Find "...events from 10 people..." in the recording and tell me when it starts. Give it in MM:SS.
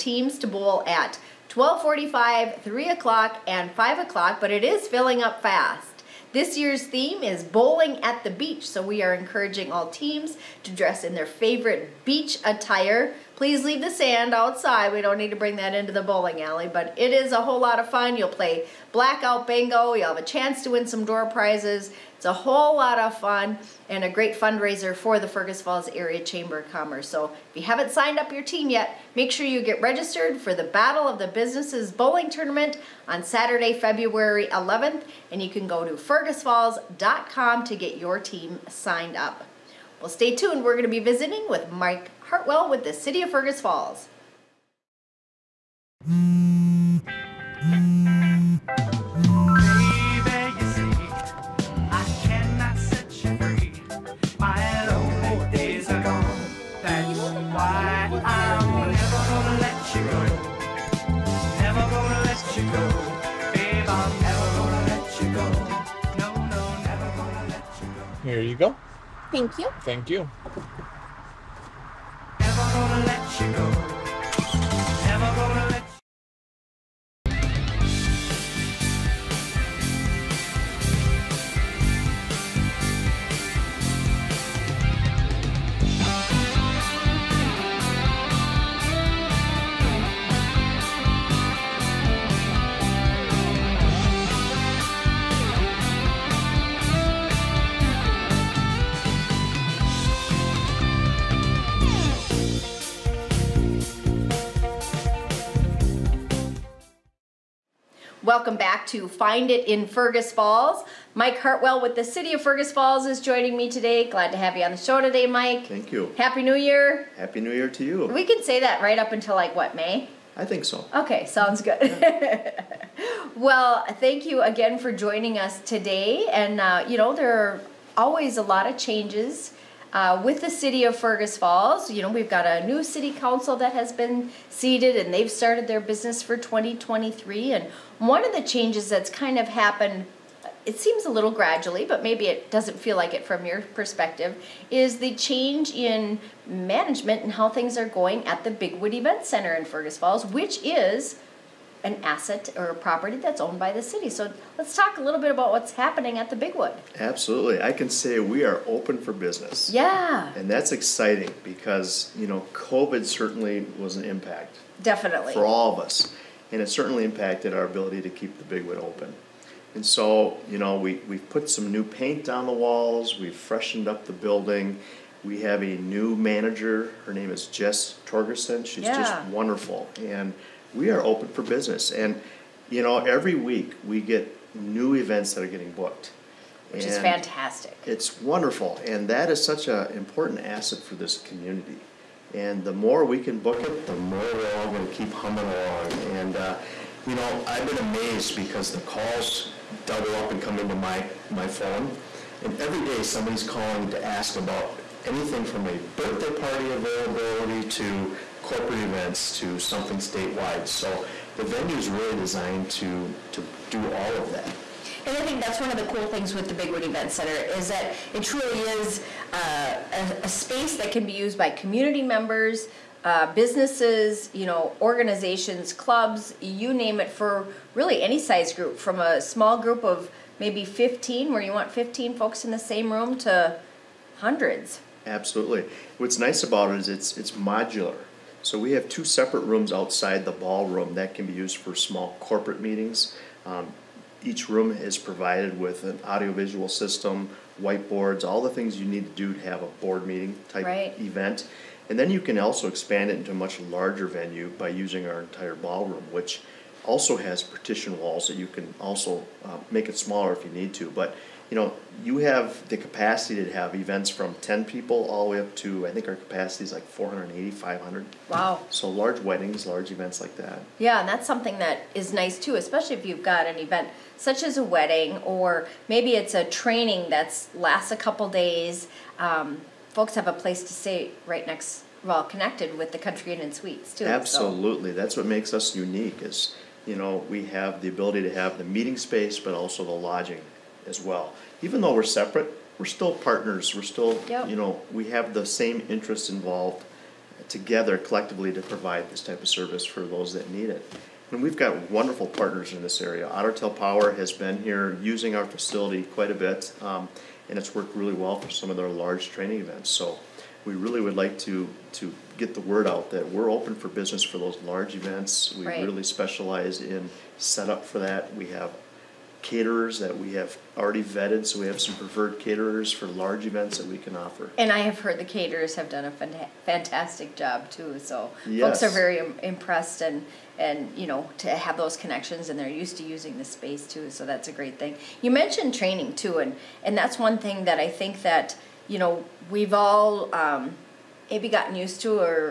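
04:23.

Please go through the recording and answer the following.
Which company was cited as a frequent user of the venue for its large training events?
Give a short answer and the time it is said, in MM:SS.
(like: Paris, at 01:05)
Otter Tail Power, at 05:03.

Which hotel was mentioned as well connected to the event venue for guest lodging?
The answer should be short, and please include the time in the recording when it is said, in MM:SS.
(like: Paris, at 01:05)
Country Inn and Suites, at 04:42.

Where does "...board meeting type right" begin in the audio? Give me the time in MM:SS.
04:09.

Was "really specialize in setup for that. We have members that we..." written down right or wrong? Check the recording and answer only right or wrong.
wrong.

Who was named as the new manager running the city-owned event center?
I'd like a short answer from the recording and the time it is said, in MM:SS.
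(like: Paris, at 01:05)
Jess Torgerson, at 02:57.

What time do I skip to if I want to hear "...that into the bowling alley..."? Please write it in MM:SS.
00:15.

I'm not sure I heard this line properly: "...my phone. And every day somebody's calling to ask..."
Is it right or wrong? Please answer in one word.
right.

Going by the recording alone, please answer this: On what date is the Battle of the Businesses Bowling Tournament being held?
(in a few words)
Saturday, February 11th.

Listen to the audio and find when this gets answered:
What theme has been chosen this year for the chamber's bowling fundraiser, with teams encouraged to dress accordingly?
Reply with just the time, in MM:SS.
00:07.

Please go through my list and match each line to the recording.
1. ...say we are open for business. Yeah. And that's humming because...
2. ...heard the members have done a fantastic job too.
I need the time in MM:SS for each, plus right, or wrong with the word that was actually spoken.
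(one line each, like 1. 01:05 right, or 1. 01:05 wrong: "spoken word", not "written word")
1. 02:37 wrong: "exciting", not "humming"
2. 05:25 wrong: "caterers", not "members".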